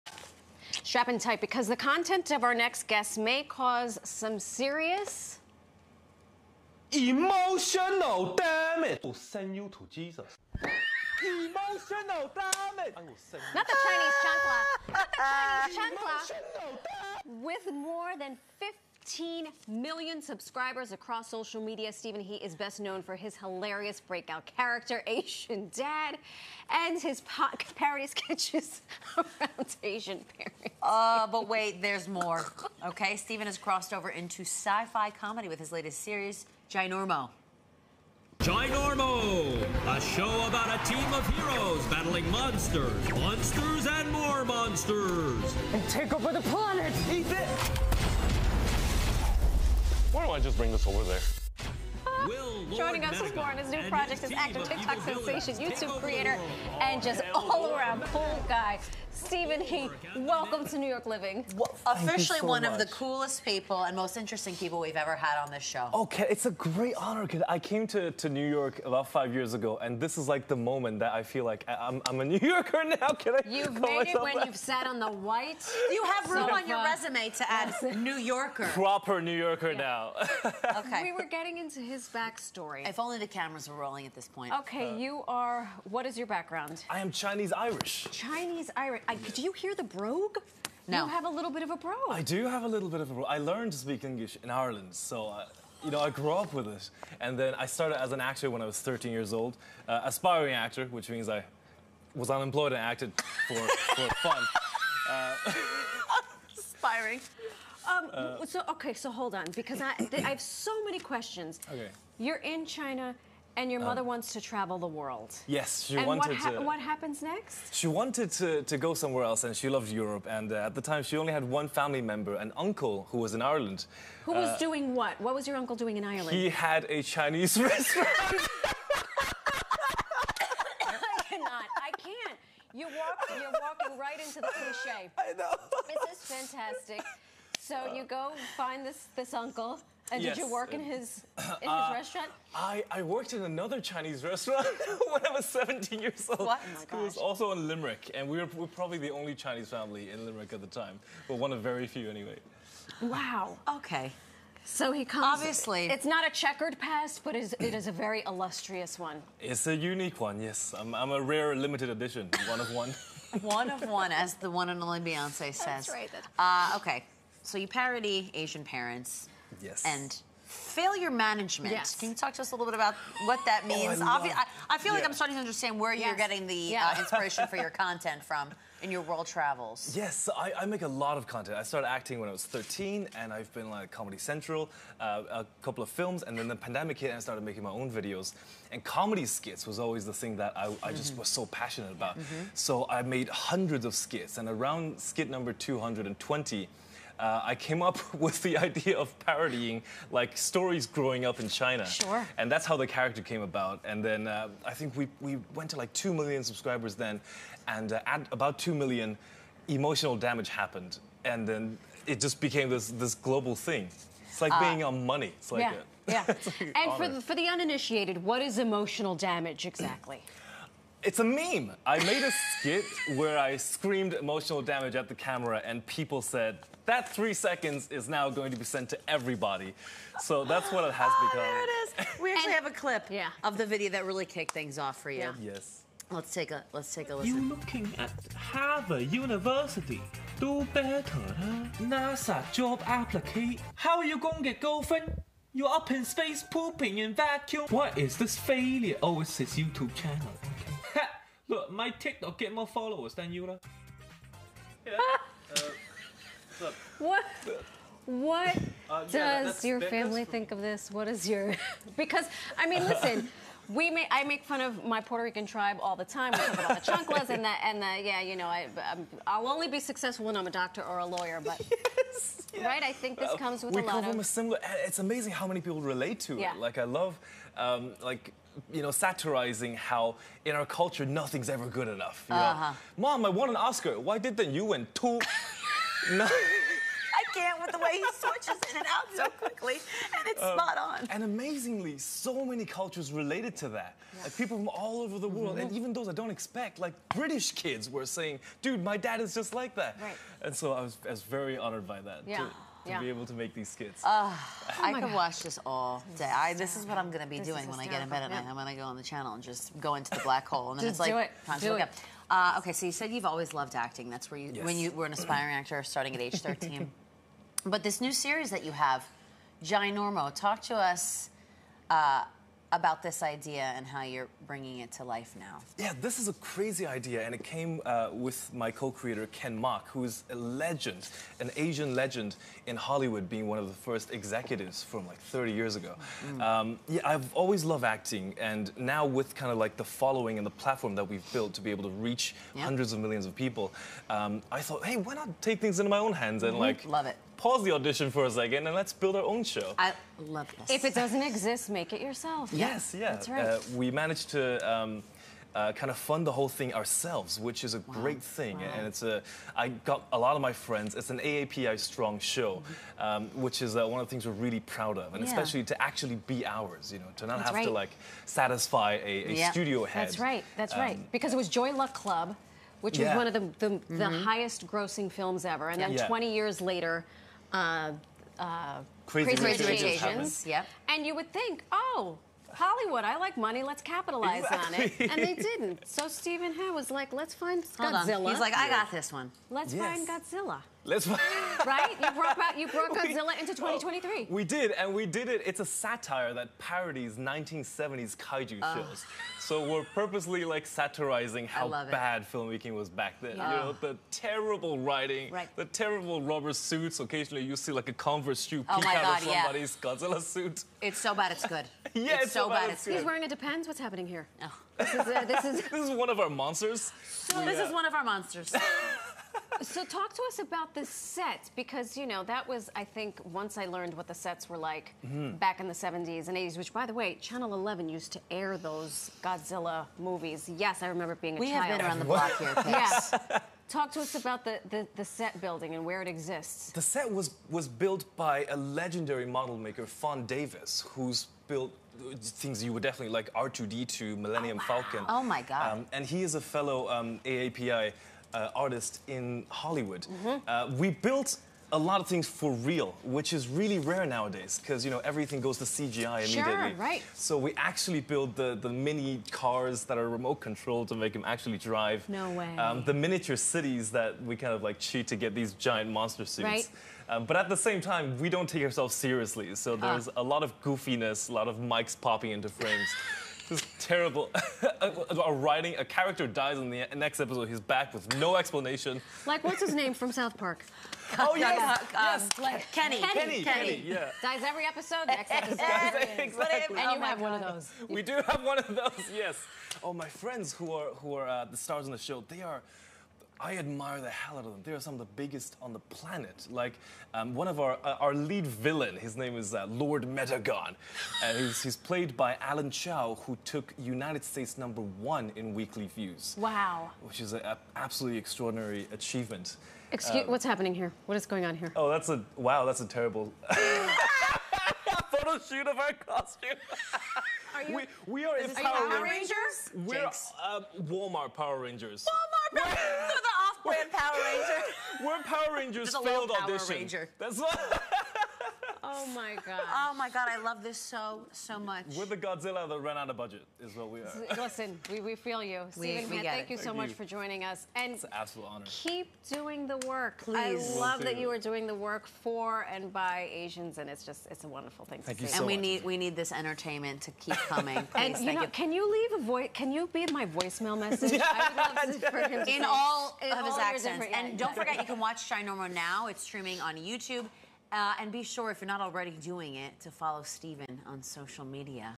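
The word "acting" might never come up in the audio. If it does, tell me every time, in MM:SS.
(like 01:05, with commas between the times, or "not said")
03:01, 05:13, 05:37.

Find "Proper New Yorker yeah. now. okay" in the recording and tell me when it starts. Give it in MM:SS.
01:18.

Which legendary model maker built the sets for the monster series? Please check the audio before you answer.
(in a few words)
Fon Davis.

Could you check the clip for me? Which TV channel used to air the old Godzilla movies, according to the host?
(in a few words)
Channel 11.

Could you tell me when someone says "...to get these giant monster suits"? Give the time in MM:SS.
07:45.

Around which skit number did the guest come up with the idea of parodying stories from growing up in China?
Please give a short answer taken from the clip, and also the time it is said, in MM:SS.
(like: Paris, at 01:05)
220, at 03:15.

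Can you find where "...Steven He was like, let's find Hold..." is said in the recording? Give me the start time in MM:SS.
06:26.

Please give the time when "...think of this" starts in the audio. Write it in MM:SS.
04:20.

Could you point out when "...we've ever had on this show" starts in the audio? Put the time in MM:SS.
01:04.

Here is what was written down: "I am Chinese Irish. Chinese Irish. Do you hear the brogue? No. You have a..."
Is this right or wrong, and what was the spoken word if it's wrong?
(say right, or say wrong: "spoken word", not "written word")
right.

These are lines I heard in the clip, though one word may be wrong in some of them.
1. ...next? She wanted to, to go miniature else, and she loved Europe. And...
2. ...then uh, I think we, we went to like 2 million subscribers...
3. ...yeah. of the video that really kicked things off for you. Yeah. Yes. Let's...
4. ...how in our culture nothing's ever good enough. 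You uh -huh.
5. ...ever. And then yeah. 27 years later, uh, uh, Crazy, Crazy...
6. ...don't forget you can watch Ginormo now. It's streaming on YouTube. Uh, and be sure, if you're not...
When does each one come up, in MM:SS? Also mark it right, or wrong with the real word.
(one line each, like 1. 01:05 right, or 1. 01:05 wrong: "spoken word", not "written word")
1. 01:57 wrong: "somewhere", not "miniature"
2. 03:24 right
3. 03:53 right
4. 04:39 right
5. 06:15 wrong: "20", not "27"
6. 09:14 right.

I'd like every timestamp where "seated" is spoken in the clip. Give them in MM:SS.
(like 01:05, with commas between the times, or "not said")
not said.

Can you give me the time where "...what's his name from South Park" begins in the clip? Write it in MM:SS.
07:59.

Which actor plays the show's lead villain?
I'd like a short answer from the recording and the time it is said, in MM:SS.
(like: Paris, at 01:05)
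Alan Chow, at 08:22.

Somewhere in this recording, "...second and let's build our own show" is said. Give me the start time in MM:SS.
05:48.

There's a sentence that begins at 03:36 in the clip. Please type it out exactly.
like and for the, for the uninitiated, what is emotional damage exactly?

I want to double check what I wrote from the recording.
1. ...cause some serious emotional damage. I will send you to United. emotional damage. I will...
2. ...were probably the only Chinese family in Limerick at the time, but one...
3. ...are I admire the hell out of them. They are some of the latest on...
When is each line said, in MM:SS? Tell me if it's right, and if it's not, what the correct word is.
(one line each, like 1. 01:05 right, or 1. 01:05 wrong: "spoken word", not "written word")
1. 00:03 wrong: "Jesus", not "United"
2. 02:28 right
3. 08:12 wrong: "biggest", not "latest".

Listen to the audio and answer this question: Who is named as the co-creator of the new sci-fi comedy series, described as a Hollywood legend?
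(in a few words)
Ken Mok.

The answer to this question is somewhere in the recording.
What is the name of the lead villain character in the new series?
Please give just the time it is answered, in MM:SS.
08:19.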